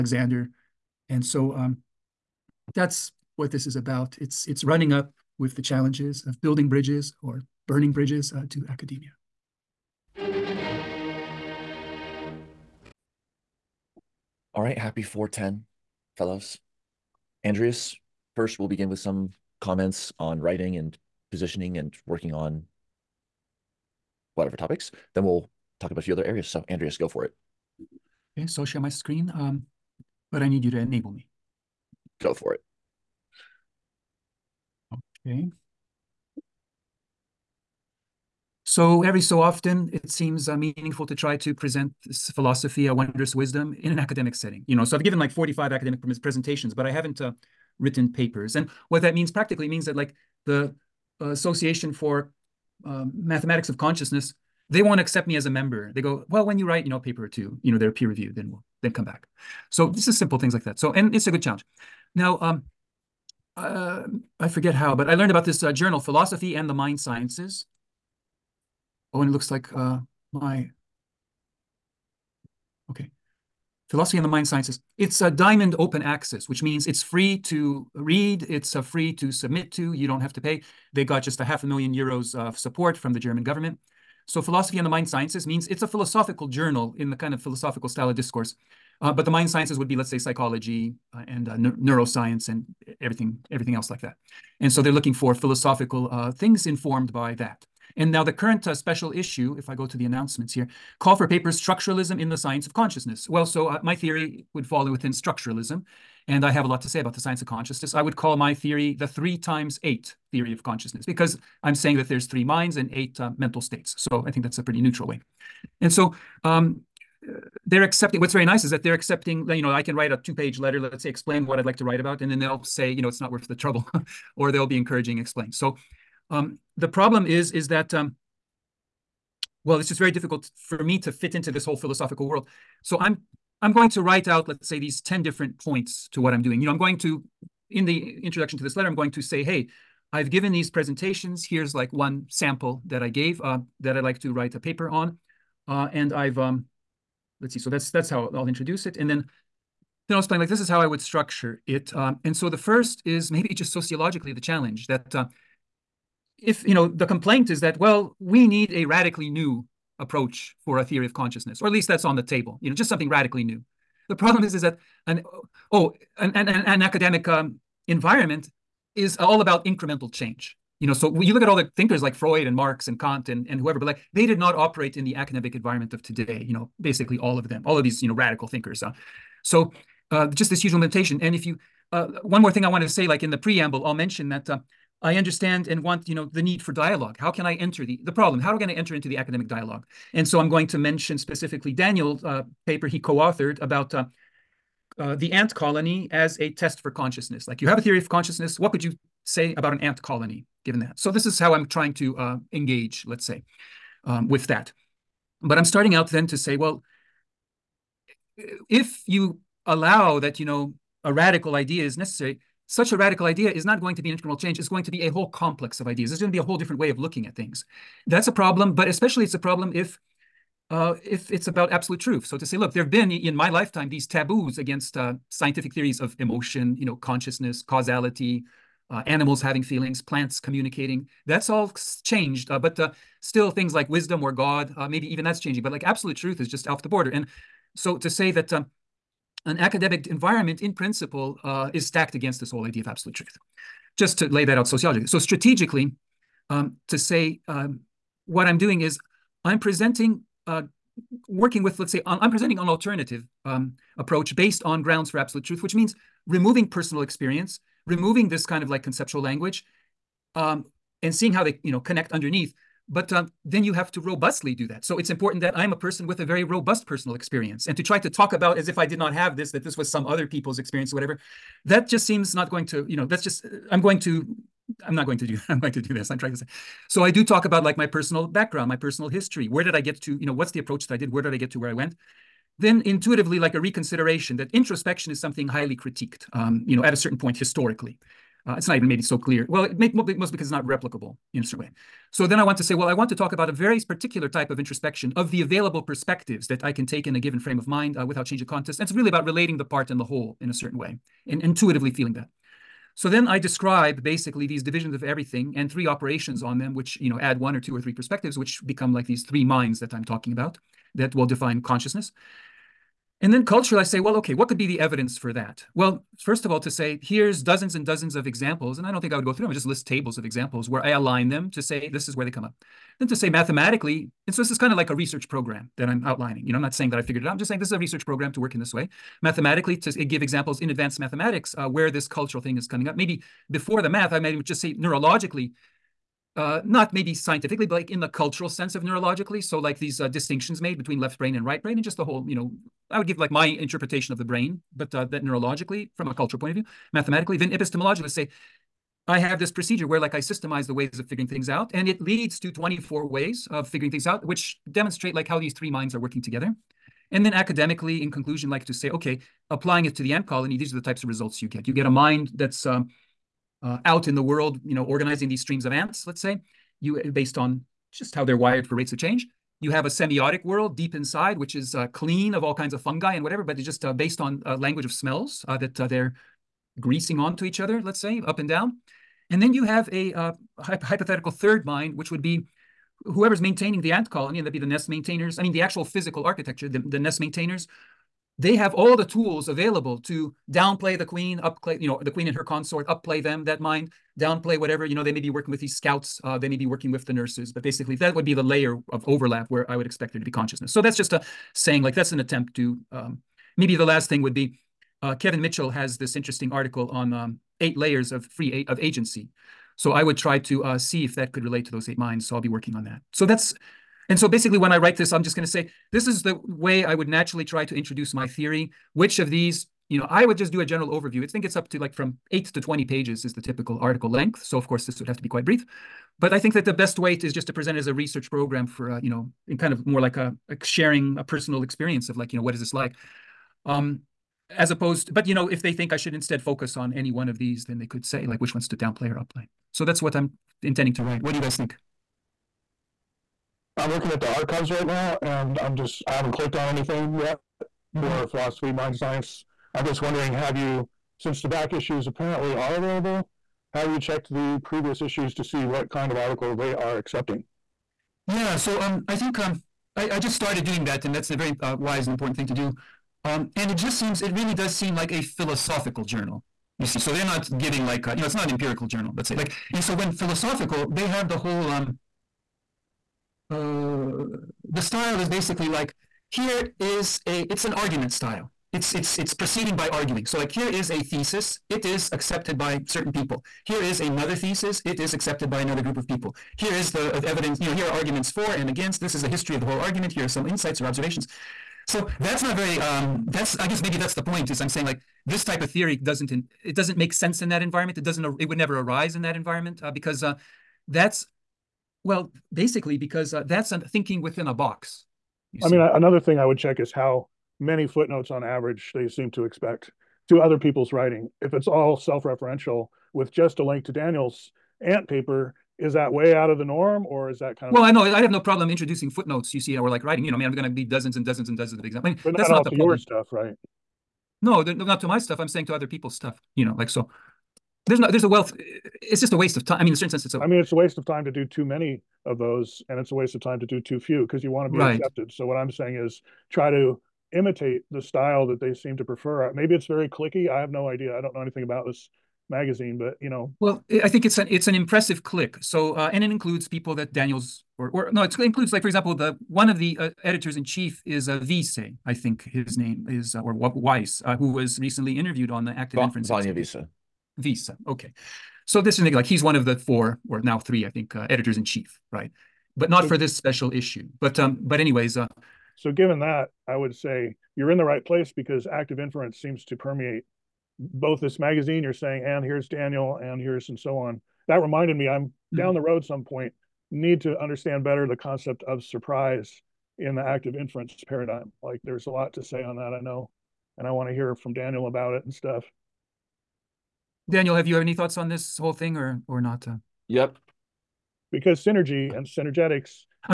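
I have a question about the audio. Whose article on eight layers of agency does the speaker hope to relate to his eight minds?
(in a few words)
Kevin Mitchell.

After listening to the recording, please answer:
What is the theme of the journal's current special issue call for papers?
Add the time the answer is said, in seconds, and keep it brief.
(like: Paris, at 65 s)
Structuralism in the science of consciousness, at 101 s.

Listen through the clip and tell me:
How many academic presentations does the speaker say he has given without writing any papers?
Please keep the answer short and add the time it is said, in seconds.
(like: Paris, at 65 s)
45, at 45 s.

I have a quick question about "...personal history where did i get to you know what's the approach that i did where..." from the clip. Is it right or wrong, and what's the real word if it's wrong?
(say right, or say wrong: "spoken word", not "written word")
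right.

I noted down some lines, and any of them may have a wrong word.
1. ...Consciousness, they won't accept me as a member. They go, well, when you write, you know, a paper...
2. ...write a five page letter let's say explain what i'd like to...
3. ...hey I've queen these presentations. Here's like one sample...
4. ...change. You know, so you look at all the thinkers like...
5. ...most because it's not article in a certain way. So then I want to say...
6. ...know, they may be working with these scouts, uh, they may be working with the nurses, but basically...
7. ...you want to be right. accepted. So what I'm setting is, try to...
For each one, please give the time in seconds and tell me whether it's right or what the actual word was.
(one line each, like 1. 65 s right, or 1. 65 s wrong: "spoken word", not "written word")
1. 53 s right
2. 119 s wrong: "two", not "five"
3. 139 s wrong: "given", not "queen"
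4. 170 s right
5. 289 s wrong: "replicable", not "article"
6. 394 s right
7. 534 s wrong: "saying", not "setting".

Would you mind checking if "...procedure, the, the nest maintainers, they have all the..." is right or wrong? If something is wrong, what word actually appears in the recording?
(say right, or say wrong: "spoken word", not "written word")
wrong: "architecture", not "procedure".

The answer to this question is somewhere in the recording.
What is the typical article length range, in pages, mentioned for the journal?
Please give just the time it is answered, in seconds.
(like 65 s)
422 s.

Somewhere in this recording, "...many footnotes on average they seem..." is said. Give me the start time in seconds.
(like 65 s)
507 s.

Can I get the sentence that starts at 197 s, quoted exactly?
Like you have a theory of consciousness.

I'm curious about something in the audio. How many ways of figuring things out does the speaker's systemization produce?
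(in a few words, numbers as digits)
24.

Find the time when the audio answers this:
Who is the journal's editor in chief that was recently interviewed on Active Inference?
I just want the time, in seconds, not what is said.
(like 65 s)
556 s.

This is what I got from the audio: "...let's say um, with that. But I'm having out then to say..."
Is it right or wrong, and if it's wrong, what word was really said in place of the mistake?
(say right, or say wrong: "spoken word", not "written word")
wrong: "starting", not "having".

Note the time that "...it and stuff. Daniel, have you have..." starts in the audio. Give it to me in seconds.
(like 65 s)
585 s.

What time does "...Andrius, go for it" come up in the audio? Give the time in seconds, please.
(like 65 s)
26 s.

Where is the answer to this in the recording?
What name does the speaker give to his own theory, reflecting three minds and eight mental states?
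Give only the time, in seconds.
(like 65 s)
109 s.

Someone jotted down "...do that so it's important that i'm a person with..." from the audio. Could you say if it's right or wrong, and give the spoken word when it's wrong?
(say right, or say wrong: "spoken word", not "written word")
right.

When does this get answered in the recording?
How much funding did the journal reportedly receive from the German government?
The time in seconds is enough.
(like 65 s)
81 s.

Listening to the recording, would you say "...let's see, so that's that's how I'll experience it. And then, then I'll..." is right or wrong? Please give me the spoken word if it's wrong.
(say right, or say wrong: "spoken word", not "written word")
wrong: "introduce", not "experience".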